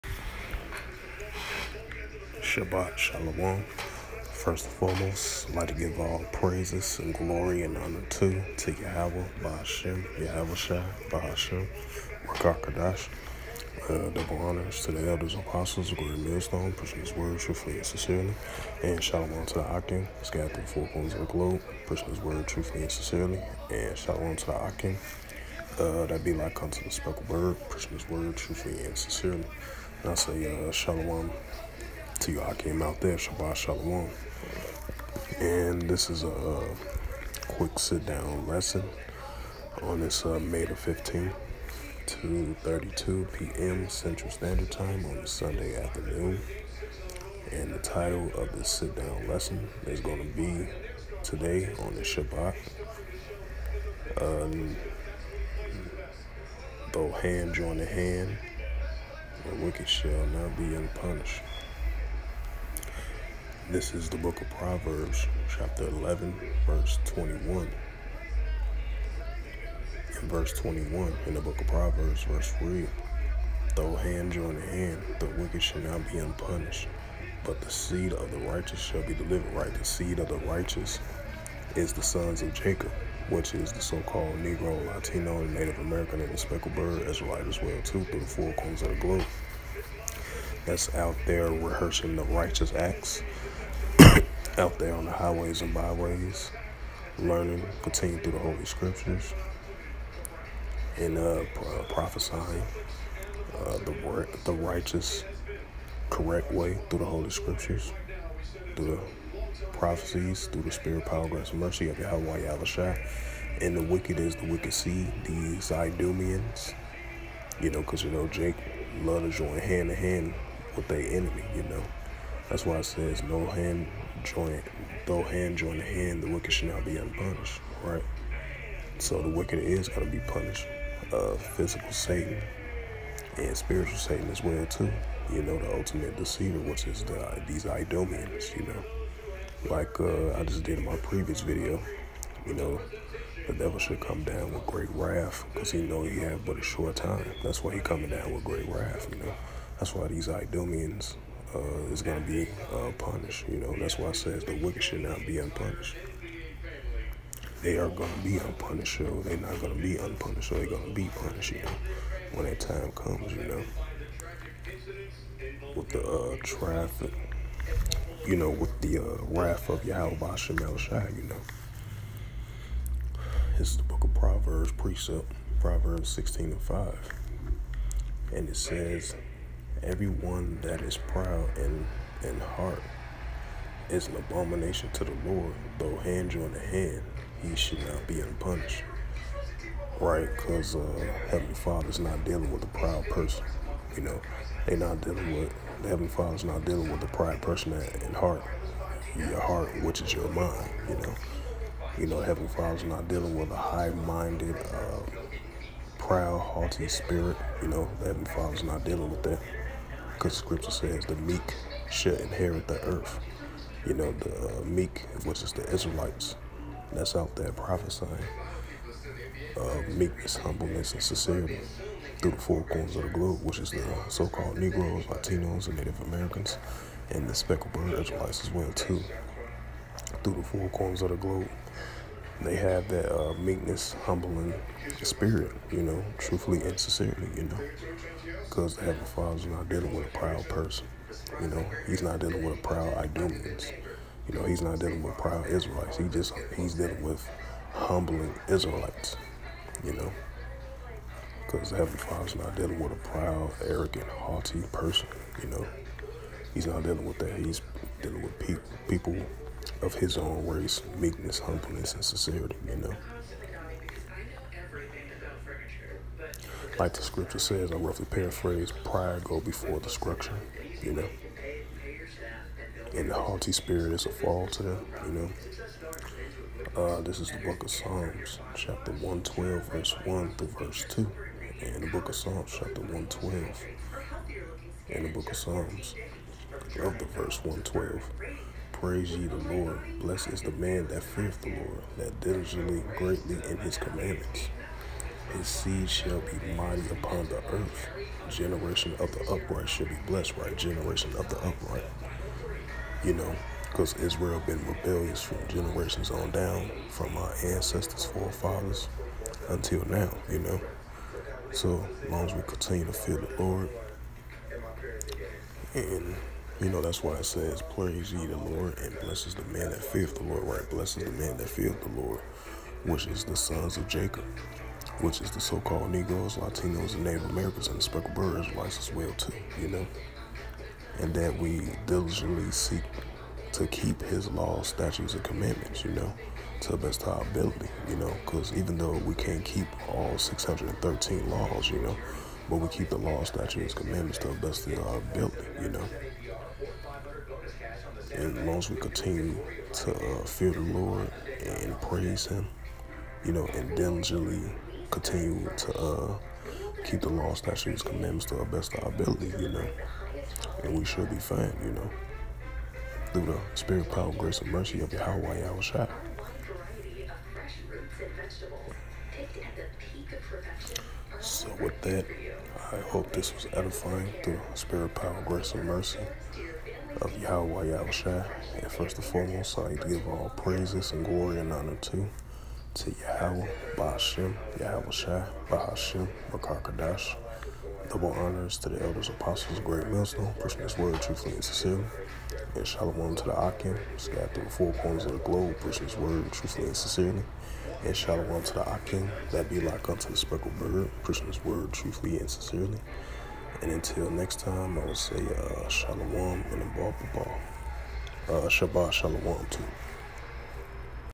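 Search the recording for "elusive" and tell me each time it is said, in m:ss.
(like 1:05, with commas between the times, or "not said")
not said.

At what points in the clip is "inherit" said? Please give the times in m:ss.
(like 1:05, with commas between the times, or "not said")
3:32.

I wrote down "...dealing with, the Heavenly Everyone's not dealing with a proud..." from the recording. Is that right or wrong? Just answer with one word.
wrong.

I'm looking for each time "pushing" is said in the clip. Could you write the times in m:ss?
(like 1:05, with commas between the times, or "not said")
0:16, 0:21, 0:27, 6:30, 6:35, 6:41.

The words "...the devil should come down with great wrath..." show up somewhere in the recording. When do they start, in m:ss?
2:23.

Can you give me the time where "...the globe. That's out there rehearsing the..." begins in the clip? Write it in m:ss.
1:28.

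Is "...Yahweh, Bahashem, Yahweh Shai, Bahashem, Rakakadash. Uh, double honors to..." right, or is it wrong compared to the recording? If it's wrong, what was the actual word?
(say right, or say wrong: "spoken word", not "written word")
right.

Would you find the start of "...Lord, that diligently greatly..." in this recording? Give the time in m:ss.
4:51.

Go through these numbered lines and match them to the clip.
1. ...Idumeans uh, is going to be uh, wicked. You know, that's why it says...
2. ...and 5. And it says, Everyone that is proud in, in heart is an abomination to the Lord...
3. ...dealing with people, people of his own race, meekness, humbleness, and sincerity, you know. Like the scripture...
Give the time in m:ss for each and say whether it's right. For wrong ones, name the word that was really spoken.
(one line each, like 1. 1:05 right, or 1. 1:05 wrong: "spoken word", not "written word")
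1. 2:30 wrong: "punished", not "wicked"
2. 2:56 right
3. 4:18 right.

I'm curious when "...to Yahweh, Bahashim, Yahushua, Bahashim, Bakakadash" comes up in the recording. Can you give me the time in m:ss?
6:22.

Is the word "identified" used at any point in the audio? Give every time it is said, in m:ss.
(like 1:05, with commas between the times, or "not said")
not said.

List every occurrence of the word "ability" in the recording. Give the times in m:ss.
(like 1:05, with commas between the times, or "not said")
5:37, 5:44, 5:58.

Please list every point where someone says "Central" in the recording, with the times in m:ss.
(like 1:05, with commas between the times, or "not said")
0:43.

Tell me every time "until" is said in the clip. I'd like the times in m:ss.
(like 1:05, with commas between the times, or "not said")
5:09, 6:43.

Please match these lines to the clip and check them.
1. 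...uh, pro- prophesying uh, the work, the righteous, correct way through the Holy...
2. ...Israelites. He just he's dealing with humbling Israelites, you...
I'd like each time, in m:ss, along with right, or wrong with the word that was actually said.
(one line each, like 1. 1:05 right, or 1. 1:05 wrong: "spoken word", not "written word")
1. 1:41 right
2. 4:05 right.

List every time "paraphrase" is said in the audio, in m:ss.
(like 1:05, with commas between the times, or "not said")
4:28.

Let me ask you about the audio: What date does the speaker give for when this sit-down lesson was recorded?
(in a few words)
May 15th.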